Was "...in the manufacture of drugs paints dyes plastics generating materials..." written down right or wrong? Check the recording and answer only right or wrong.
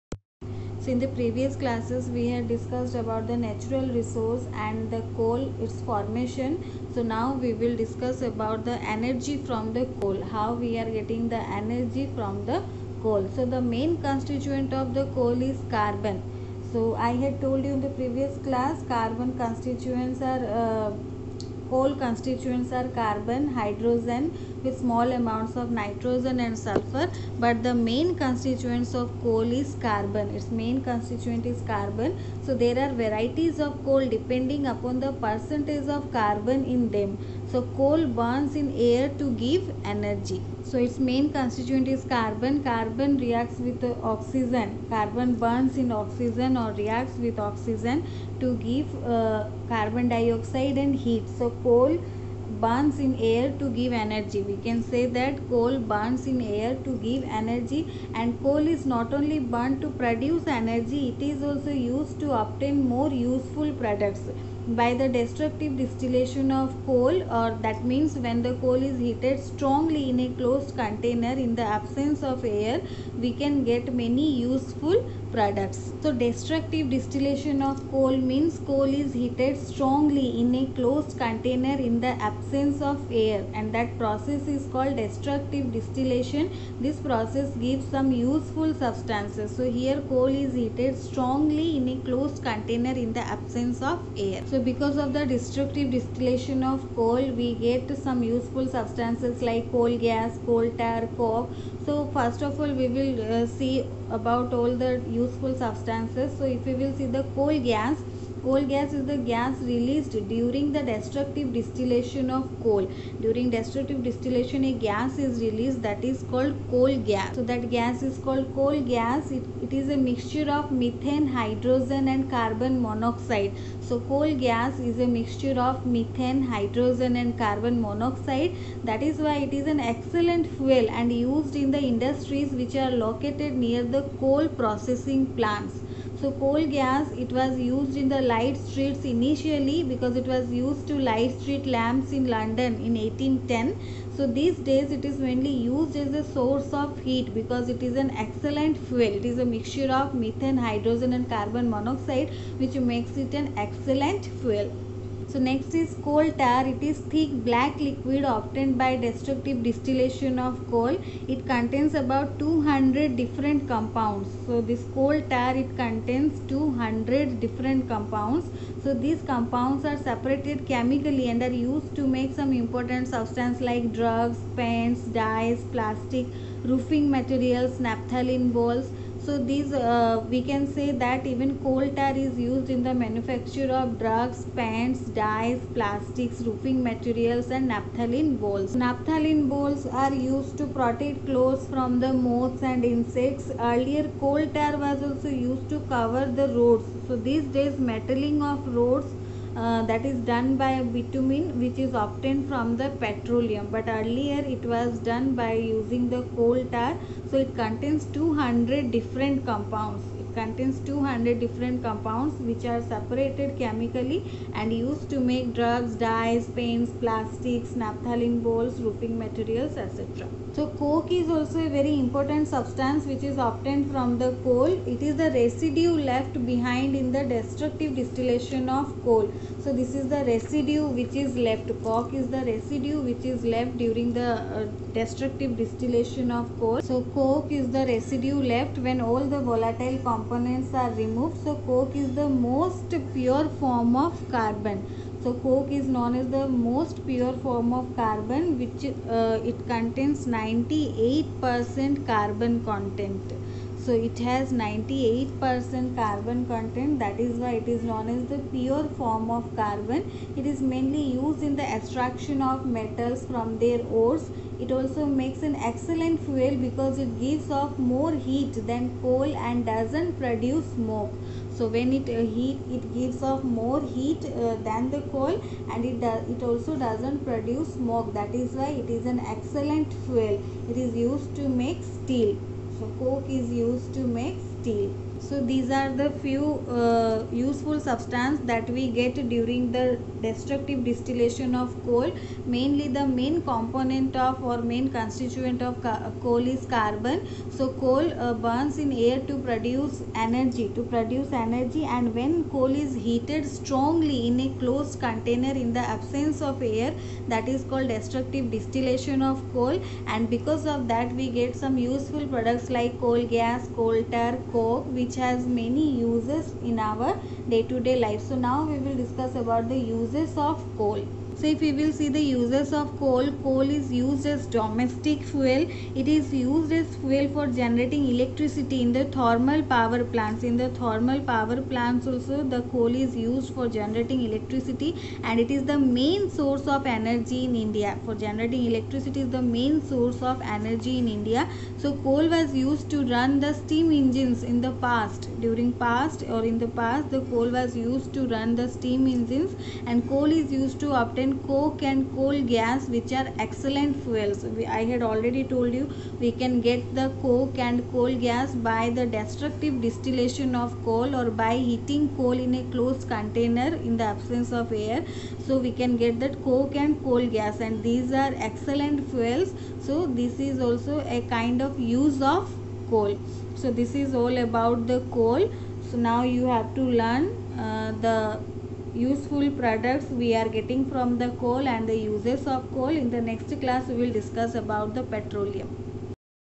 wrong.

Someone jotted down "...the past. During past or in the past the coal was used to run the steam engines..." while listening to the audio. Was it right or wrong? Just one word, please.
right.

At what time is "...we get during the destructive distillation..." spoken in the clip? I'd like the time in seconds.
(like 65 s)
288 s.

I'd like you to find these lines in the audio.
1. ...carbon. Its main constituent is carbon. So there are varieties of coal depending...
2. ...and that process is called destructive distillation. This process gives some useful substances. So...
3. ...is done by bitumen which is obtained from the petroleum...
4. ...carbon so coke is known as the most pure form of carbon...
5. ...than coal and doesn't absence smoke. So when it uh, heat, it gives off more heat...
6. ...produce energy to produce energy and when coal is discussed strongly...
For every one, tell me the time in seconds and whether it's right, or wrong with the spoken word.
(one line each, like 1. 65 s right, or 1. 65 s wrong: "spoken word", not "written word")
1. 29 s right
2. 83 s right
3. 200 s right
4. 244 s right
5. 268 s wrong: "produce", not "absence"
6. 299 s wrong: "heated", not "discussed".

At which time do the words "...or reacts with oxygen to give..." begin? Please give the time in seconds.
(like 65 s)
46 s.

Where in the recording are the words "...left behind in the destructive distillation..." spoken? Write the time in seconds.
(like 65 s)
226 s.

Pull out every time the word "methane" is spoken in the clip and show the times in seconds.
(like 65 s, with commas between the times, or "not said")
120 s, 125 s, 150 s.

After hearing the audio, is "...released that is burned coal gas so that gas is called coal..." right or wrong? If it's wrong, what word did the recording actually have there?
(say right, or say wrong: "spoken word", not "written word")
wrong: "called", not "burned".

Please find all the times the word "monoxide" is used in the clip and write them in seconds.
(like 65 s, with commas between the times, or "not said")
122 s, 127 s, 151 s.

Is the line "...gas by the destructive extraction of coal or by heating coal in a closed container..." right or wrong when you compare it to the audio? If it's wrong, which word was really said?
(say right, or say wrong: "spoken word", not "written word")
wrong: "distillation", not "extraction".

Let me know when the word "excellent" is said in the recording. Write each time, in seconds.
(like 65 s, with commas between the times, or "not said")
129 s, 148 s, 153 s, 265 s, 279 s, 353 s, 368 s.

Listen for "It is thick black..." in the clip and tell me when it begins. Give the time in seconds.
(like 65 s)
156 s.